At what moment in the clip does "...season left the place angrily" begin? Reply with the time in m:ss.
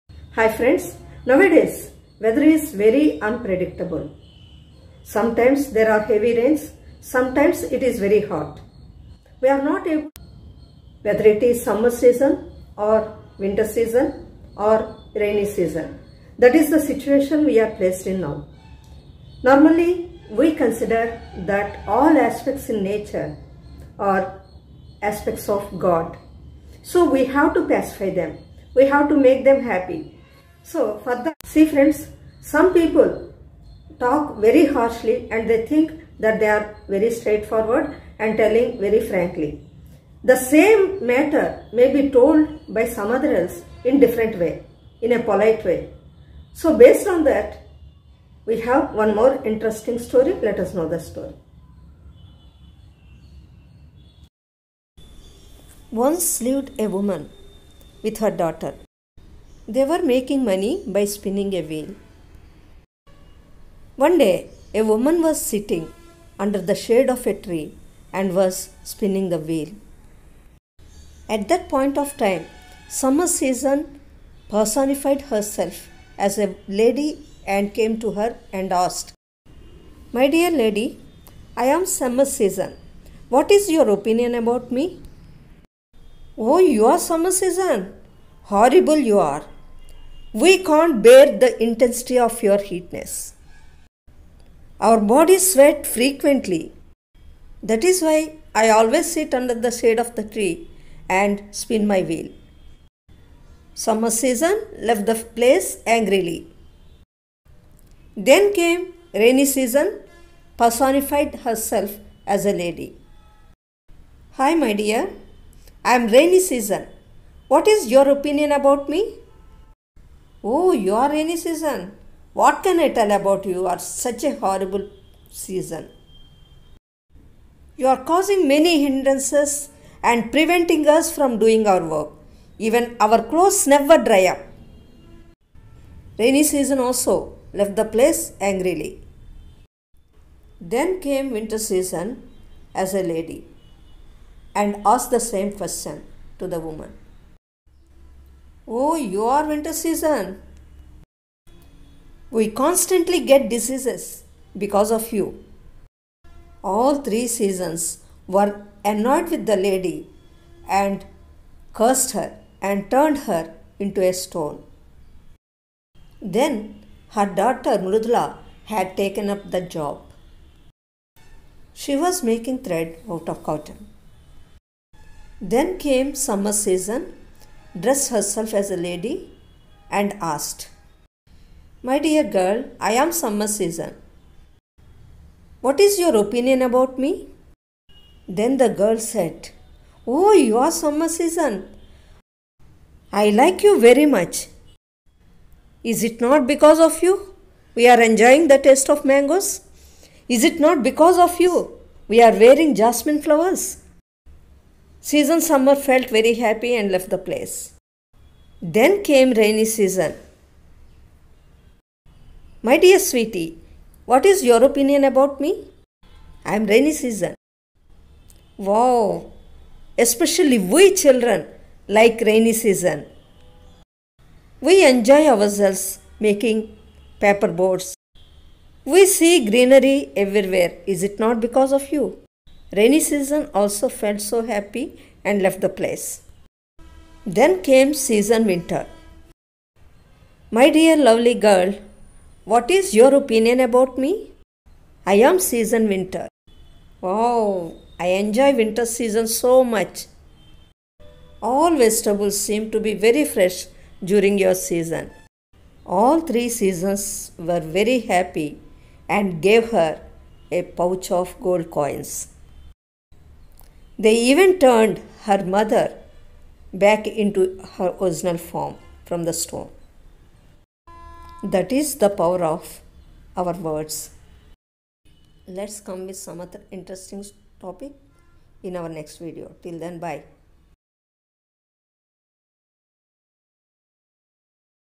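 1:44.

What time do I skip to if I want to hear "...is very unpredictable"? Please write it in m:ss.
0:02.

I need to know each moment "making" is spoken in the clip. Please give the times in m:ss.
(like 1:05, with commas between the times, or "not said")
1:00, 2:52, 3:46.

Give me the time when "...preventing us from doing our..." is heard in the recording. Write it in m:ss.
2:10.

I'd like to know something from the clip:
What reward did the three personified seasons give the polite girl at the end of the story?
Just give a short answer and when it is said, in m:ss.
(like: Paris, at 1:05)
A pouch of gold coins, at 4:20.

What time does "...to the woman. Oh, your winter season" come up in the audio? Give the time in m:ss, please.
2:26.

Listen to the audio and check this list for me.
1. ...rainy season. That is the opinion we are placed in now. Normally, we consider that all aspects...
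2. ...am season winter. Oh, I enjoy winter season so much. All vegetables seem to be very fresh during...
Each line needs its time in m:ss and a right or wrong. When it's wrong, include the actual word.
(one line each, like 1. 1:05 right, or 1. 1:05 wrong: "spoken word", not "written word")
1. 0:15 wrong: "situation", not "opinion"
2. 4:05 right.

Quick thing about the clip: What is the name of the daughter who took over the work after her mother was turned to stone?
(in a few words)
Mrudla.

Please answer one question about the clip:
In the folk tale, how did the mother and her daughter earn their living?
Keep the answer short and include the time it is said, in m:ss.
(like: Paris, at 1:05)
Spinning a wheel, at 1:01.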